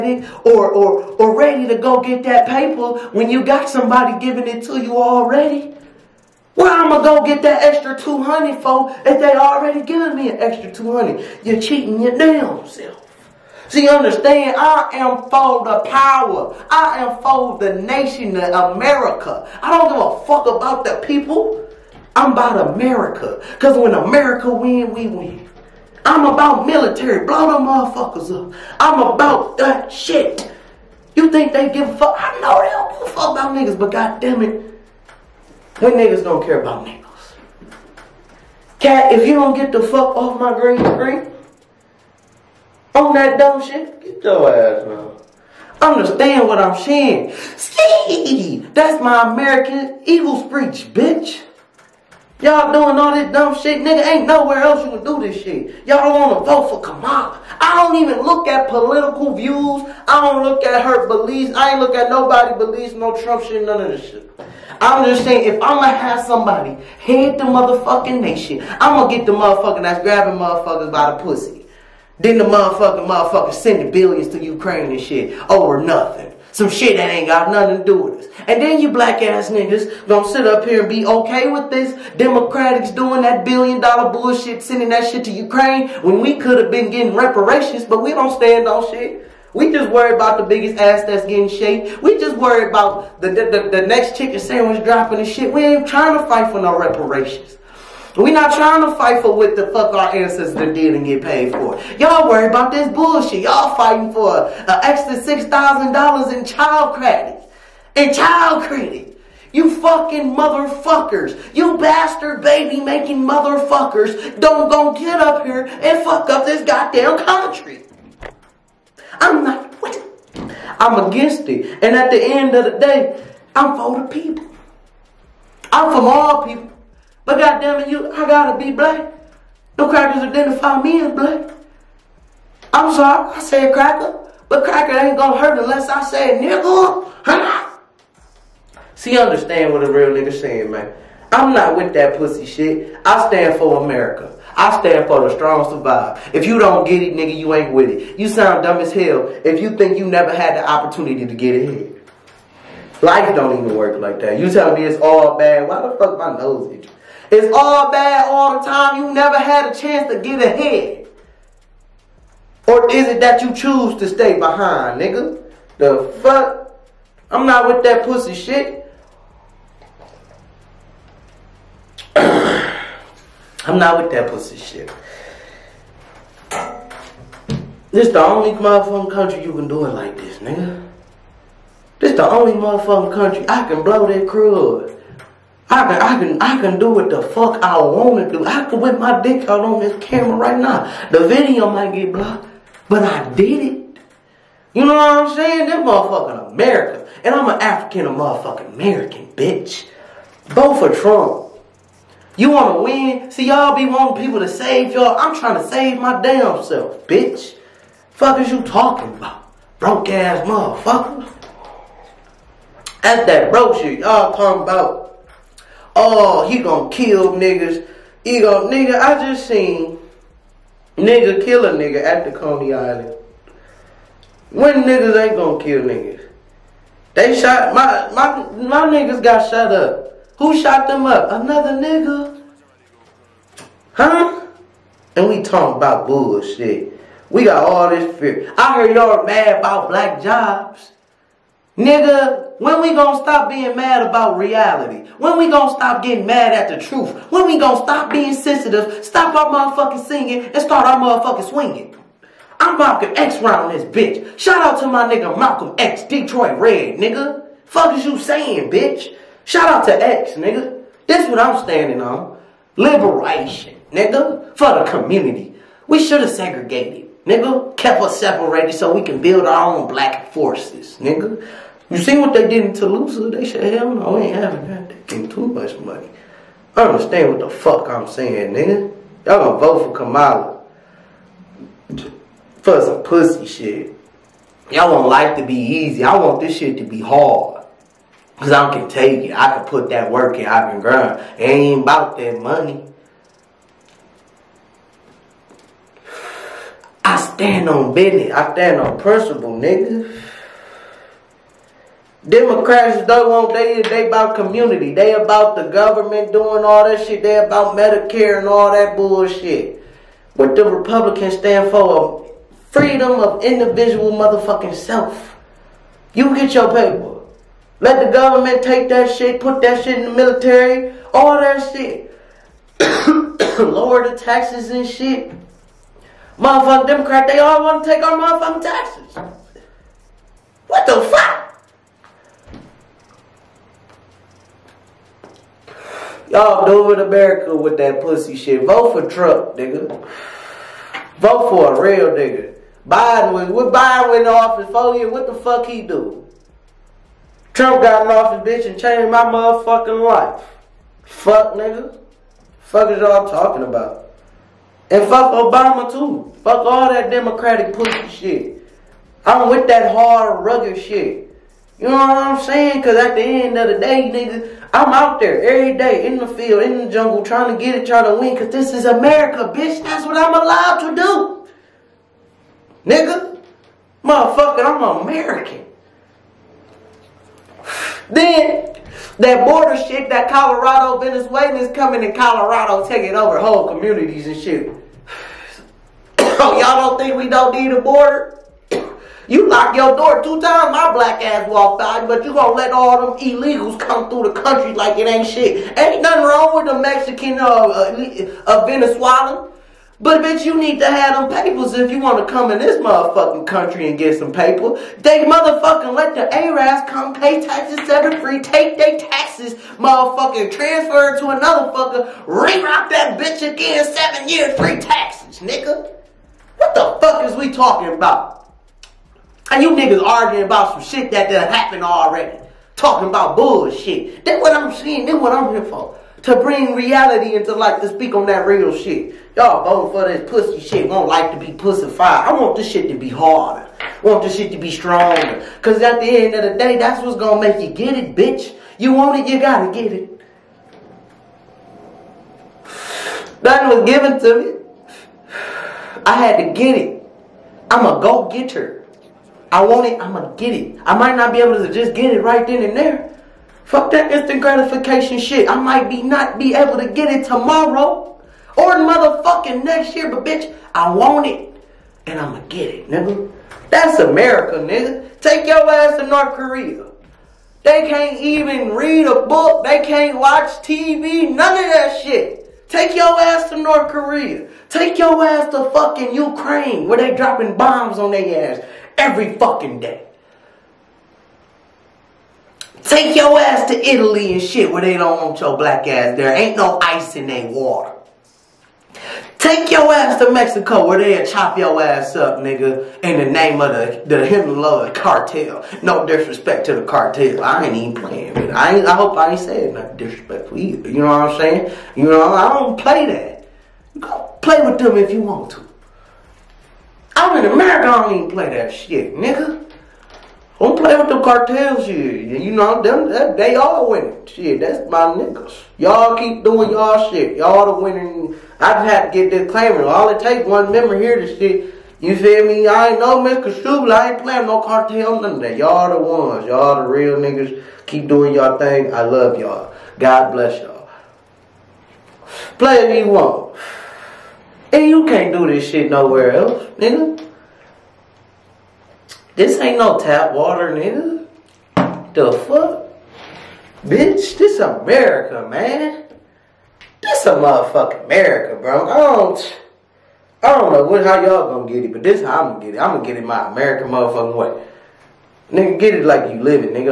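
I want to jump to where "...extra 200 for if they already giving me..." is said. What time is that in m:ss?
0:07.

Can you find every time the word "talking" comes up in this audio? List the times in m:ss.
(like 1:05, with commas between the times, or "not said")
3:28, 3:34, 3:55, 5:53, 6:57, 7:02.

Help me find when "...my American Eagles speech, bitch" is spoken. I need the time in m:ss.
0:49.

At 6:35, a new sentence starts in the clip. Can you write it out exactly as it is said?
Ain't nothing wrong with the Mexican or uh, uh, Venezuelan.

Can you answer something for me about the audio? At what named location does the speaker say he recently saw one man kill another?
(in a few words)
Coney Island.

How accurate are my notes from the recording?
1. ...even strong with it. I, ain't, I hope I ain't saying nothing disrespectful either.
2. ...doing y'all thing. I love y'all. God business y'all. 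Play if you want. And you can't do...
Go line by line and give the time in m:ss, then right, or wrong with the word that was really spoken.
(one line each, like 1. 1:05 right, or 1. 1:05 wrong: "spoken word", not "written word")
1. 8:17 wrong: "playing", not "strong"
2. 8:48 wrong: "bless", not "business".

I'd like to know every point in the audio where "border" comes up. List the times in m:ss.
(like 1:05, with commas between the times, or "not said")
6:19, 6:27.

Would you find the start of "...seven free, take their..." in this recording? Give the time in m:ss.
6:47.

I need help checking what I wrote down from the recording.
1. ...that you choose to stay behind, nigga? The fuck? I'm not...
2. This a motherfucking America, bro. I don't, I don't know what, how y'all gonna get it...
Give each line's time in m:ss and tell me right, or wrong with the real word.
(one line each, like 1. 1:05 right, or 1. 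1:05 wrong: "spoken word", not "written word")
1. 2:43 right
2. 9:07 right.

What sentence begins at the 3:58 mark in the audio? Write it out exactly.
I heard y'all mad about black jobs.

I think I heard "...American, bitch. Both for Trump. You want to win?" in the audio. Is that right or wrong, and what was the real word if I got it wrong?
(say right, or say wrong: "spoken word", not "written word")
right.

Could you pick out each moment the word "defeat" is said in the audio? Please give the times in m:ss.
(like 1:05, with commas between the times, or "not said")
not said.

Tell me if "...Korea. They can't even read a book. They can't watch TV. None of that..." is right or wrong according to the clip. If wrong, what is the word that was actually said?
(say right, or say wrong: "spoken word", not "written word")
right.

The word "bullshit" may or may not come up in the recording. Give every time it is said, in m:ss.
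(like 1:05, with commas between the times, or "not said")
1:24, 1:42, 3:56, 5:08, 7:03.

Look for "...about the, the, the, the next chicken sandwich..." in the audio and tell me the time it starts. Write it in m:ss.
1:32.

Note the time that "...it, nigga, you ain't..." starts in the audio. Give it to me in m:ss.
2:27.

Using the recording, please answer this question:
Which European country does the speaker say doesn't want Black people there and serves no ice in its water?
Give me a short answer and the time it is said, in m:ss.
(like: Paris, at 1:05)
Italy, at 8:03.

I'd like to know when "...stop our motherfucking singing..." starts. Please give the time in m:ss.
4:09.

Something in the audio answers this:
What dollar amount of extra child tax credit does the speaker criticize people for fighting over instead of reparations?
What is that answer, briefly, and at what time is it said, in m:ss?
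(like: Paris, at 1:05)
$6,000, at 1:45.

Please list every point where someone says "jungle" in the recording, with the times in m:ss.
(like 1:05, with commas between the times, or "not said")
6:06.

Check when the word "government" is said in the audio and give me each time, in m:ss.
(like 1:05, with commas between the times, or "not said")
5:05, 5:18.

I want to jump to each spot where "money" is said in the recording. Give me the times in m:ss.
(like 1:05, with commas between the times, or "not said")
4:35, 4:52.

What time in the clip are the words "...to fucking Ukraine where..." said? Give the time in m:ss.
7:55.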